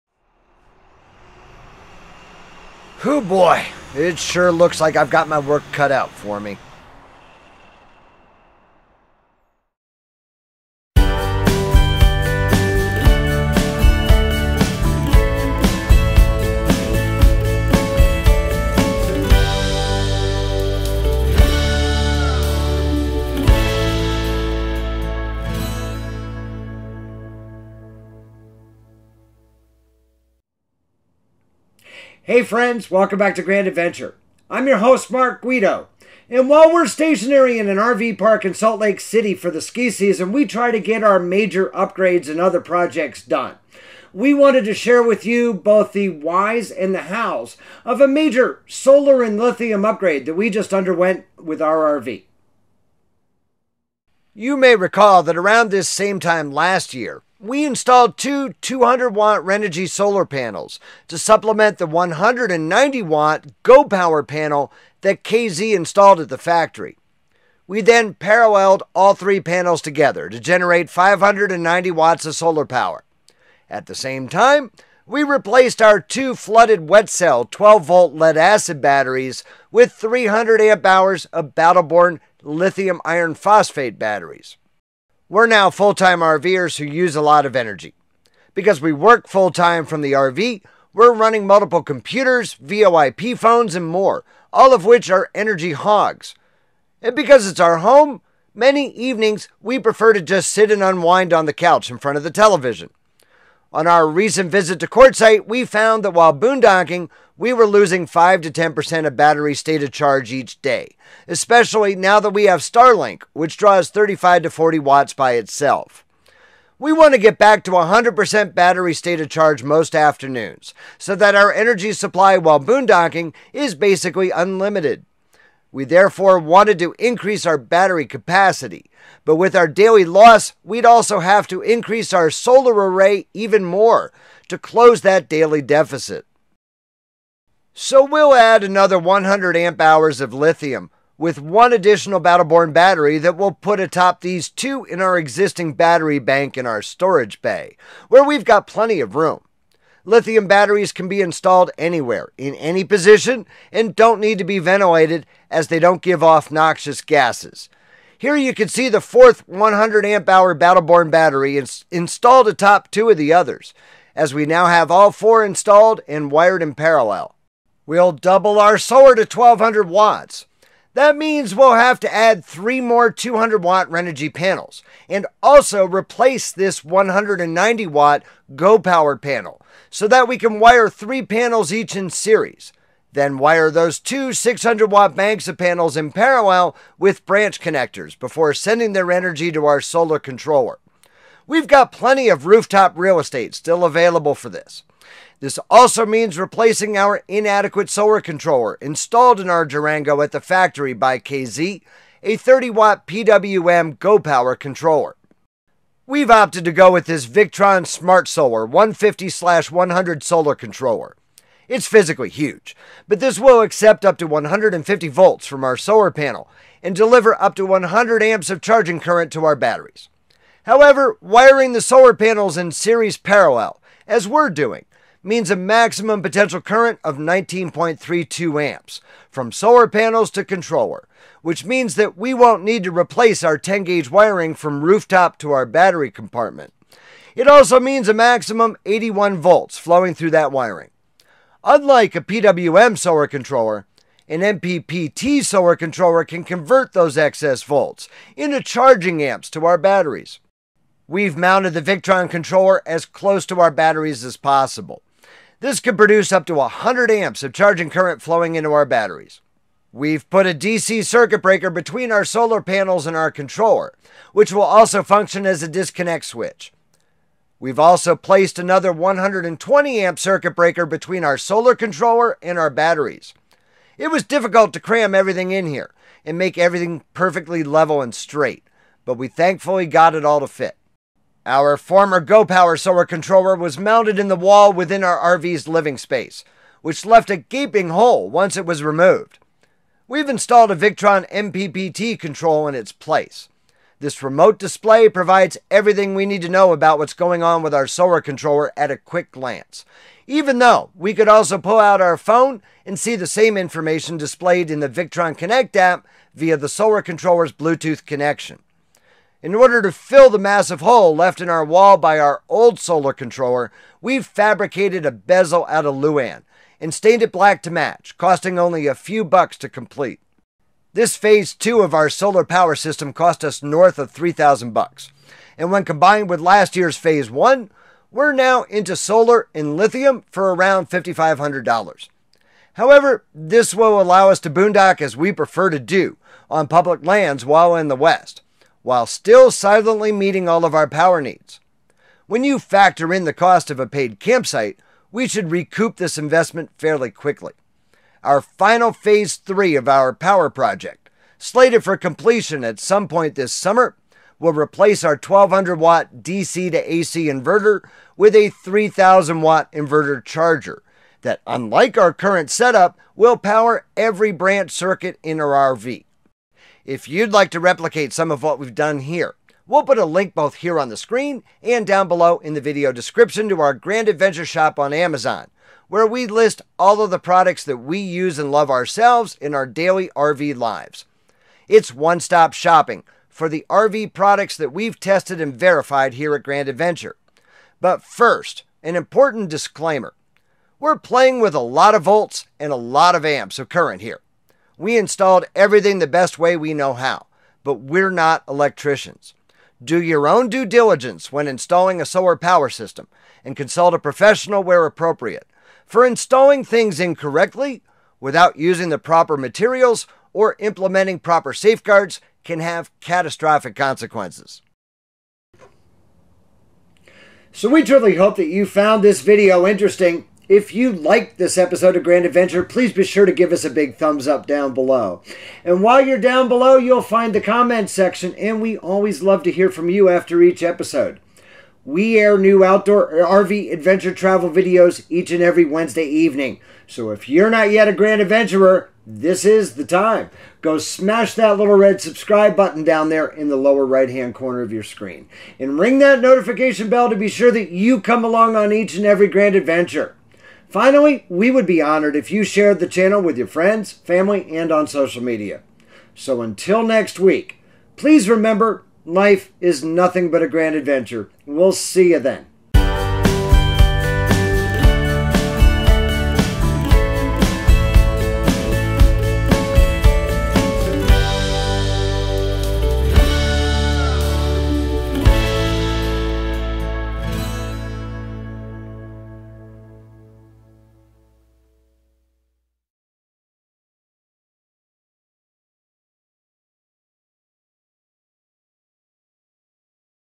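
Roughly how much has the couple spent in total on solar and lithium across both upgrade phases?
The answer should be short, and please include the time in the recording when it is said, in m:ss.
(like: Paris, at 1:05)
$5,500, at 5:30.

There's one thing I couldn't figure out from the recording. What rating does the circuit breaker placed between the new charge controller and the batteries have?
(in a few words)
120 amp.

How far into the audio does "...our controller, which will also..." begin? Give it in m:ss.
4:23.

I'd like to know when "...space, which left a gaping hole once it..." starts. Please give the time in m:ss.
4:45.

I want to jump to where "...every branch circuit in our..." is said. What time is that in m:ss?
6:03.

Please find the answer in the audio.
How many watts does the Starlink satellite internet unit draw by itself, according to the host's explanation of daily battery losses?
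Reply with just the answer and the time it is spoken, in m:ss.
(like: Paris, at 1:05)
35 to 40 watts, at 1:53.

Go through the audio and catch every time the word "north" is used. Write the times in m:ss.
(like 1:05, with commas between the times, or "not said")
5:23.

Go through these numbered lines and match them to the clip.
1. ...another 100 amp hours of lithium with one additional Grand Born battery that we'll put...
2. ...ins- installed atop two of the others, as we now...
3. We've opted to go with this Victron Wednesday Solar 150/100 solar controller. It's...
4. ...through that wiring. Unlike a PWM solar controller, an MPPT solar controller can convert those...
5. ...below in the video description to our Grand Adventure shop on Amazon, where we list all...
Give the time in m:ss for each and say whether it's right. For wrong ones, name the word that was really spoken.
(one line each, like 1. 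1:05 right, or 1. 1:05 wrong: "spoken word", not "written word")
1. 2:18 wrong: "Battle", not "Grand"
2. 2:41 right
3. 3:26 wrong: "Smart", not "Wednesday"
4. 4:00 right
5. 6:12 right.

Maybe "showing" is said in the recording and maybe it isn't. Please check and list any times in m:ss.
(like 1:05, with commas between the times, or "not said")
not said.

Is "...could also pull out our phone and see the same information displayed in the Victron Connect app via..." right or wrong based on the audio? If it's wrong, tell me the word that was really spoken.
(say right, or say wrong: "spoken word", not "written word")
right.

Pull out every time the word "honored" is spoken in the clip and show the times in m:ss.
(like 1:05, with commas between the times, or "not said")
7:31.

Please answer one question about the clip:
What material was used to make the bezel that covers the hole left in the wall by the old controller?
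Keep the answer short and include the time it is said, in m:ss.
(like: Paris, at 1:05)
Luan, at 5:15.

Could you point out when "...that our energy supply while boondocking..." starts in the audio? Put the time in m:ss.
2:01.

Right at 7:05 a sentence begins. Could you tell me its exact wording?
And while you're down below, you'll find the comment section, and we always love to hear from you after each episode.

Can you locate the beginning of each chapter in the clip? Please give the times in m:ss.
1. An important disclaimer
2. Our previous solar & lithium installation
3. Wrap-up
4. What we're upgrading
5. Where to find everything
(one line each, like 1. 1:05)
1. 6:28
2. 0:53
3. 6:56
4. 2:17
5. 6:07.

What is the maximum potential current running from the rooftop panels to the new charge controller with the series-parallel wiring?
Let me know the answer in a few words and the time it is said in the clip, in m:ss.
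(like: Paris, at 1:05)
19.32 amps, at 3:47.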